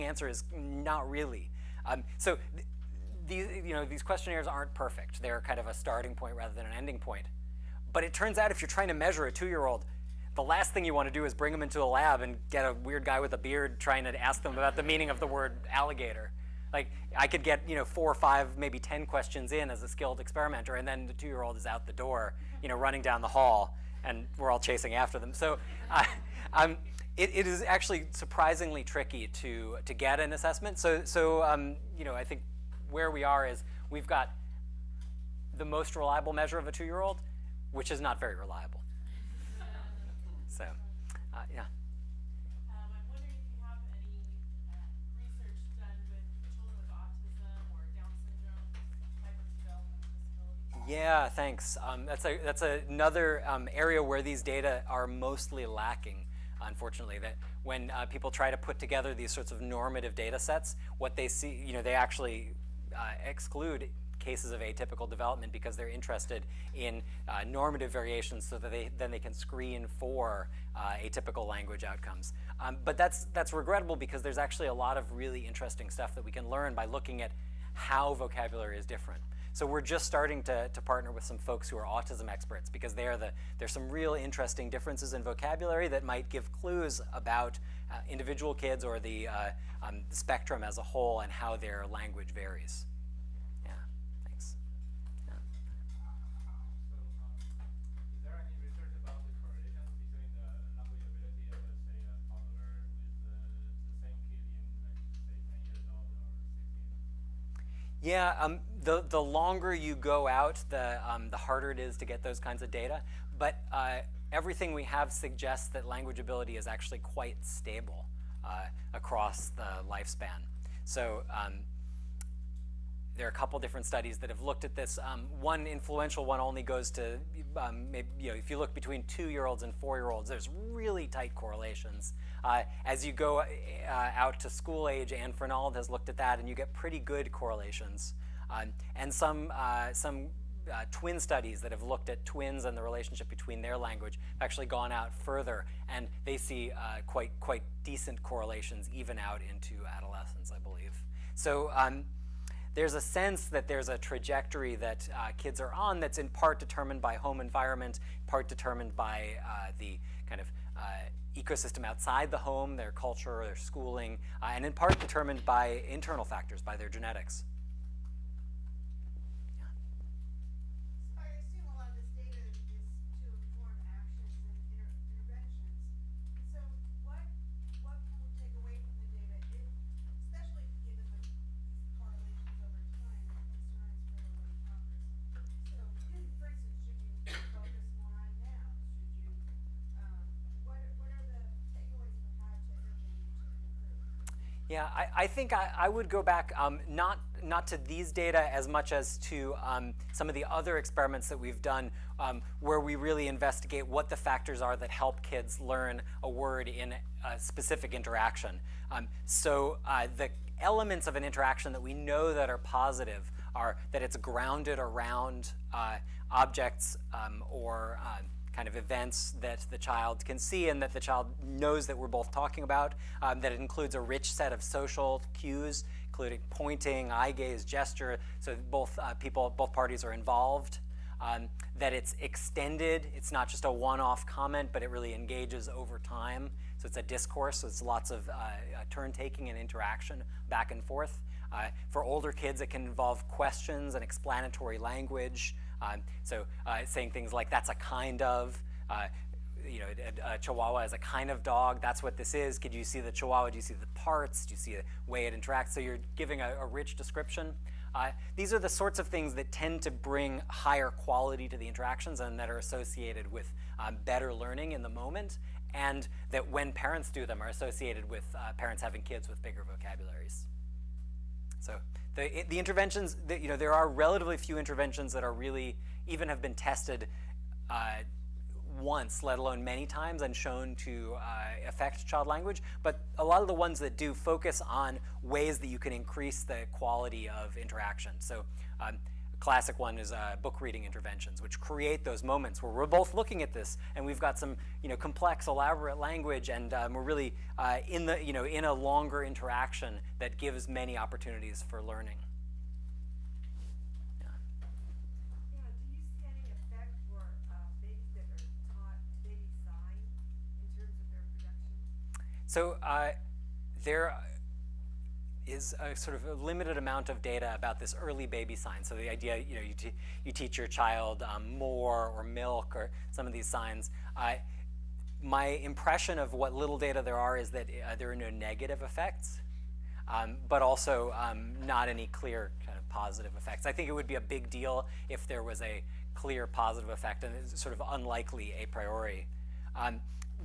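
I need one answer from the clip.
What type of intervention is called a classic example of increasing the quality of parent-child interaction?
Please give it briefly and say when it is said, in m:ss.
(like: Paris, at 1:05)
book reading, at 4:50.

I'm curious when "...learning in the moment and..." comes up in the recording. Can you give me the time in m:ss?
4:24.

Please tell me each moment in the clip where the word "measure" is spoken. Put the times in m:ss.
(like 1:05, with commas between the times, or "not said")
0:08, 0:36.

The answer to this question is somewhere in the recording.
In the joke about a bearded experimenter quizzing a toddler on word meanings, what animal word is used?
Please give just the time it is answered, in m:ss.
0:15.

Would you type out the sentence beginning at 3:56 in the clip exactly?
So it's a discourse, so it's lots of uh, uh turn-taking and interaction back and forth.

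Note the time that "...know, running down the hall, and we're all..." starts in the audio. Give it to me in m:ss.
0:22.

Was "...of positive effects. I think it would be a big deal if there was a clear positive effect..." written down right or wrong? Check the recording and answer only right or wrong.
right.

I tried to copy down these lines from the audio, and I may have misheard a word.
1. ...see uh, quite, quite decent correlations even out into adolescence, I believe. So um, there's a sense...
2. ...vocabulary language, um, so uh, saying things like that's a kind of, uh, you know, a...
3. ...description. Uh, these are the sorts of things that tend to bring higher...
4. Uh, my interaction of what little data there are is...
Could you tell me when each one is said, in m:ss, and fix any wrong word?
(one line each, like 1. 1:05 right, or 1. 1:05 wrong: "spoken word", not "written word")
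1. 2:26 right
2. 4:04 wrong: "explanatory", not "vocabulary"
3. 4:16 right
4. 5:24 wrong: "impression", not "interaction".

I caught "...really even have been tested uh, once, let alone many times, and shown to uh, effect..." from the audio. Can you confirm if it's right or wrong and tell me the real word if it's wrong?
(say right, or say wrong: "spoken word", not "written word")
wrong: "affect", not "effect".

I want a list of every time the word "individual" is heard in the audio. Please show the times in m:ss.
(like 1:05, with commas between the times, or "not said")
1:28.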